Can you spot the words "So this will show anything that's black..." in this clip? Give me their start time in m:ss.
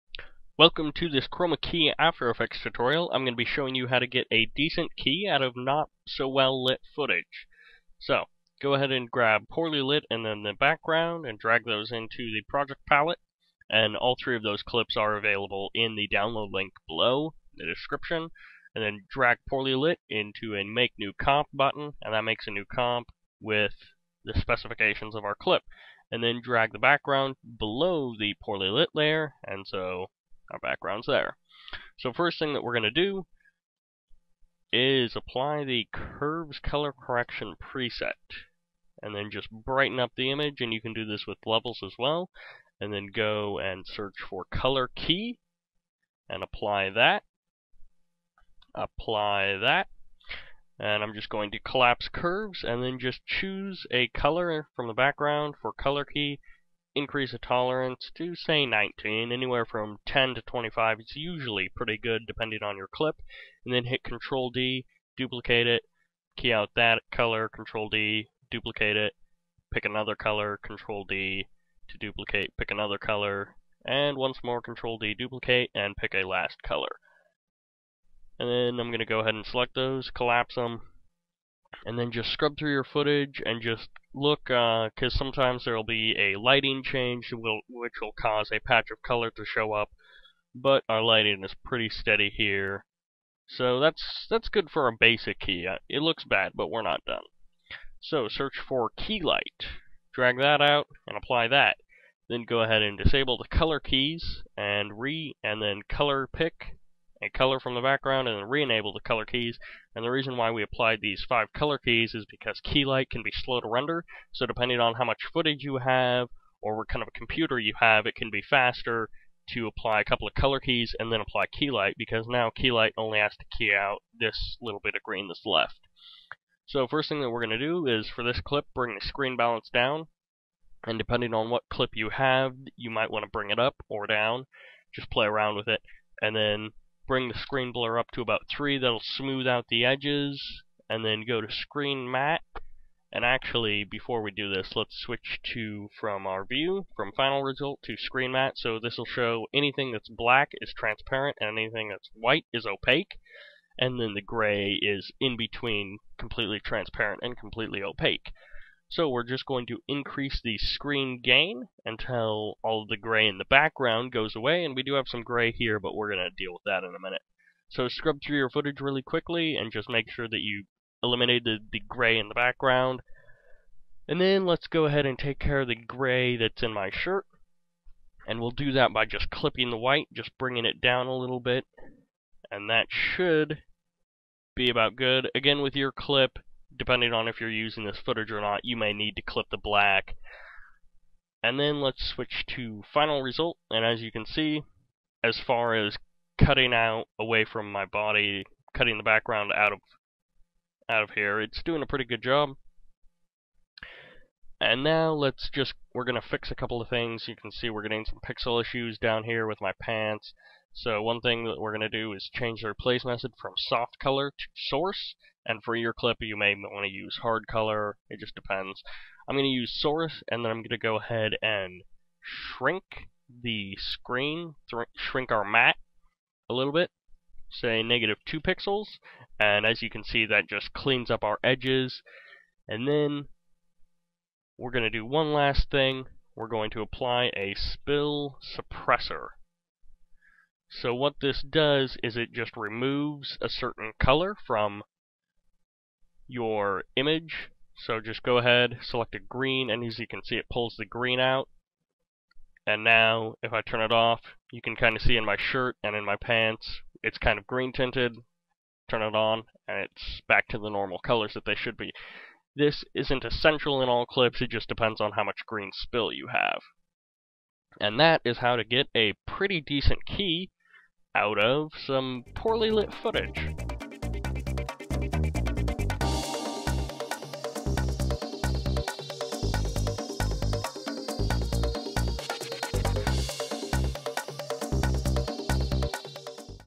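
2:28.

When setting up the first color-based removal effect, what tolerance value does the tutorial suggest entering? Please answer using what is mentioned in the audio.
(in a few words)
19.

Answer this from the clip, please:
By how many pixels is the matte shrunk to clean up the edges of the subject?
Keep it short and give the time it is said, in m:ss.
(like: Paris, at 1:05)
negative 2 pixels, at 3:47.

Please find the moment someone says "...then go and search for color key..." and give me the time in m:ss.
0:42.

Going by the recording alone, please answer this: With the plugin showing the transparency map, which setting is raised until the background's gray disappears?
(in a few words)
screen gain.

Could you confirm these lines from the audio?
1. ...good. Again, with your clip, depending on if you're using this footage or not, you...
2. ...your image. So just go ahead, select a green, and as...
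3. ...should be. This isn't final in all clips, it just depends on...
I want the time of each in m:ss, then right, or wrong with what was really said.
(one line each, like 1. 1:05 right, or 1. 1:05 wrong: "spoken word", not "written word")
1. 3:04 right
2. 4:06 right
3. 4:21 wrong: "essential", not "final".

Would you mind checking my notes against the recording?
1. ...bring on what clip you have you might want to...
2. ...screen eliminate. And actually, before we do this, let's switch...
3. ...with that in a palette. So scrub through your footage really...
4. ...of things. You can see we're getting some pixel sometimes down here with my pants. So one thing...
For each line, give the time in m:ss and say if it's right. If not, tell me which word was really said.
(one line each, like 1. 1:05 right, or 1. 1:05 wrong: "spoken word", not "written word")
1. 2:10 wrong: "depending", not "bring"
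2. 2:21 wrong: "matte", not "eliminate"
3. 2:46 wrong: "minute", not "palette"
4. 3:26 wrong: "issues", not "sometimes".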